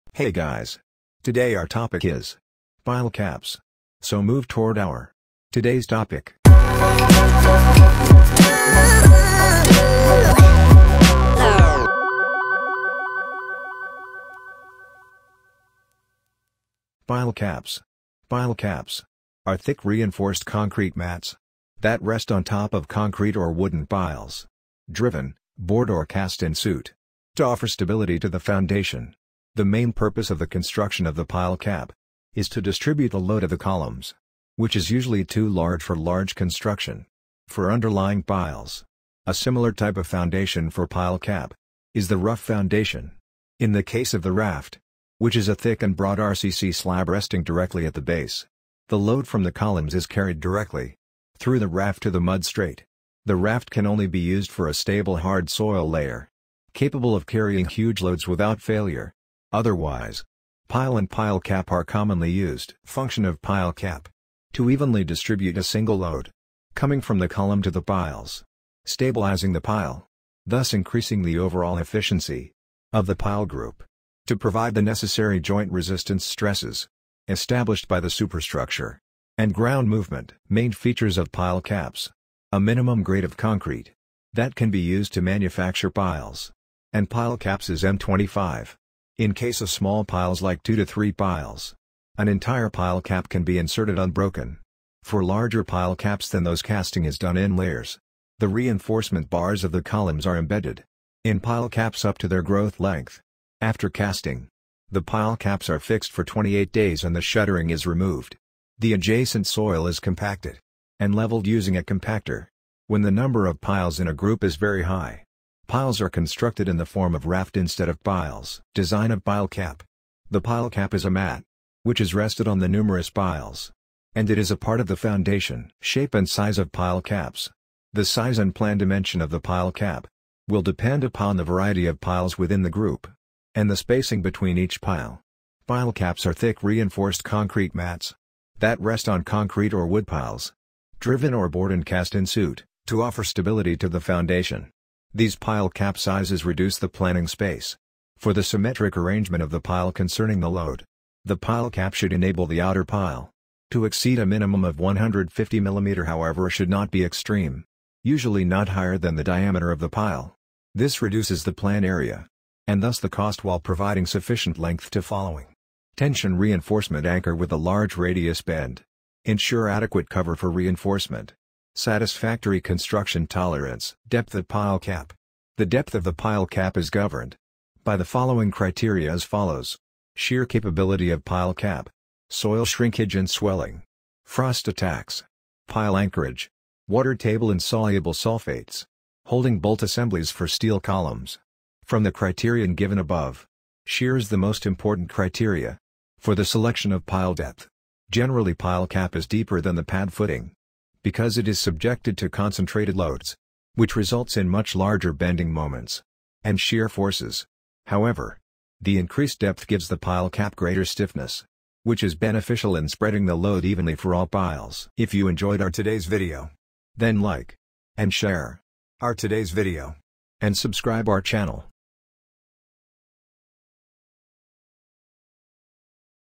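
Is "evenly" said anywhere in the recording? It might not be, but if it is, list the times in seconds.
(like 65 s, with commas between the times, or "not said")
64 s, 213 s.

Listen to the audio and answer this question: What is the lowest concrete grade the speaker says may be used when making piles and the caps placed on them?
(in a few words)
M25.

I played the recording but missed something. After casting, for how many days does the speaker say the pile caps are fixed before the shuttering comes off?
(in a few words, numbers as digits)
28 days.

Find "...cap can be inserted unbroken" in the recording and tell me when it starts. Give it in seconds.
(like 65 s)
93 s.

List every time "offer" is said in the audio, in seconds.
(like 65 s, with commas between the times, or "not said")
27 s, 143 s.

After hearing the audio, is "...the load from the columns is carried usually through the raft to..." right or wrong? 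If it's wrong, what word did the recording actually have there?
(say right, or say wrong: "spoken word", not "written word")
wrong: "directly", not "usually".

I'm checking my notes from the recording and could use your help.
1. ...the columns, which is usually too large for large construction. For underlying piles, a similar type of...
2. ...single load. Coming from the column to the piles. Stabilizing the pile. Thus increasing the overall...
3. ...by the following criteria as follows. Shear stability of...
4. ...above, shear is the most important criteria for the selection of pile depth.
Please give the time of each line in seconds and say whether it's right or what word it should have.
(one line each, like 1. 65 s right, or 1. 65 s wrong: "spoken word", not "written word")
1. 33 s right
2. 65 s right
3. 177 s wrong: "capability", not "stability"
4. 192 s right.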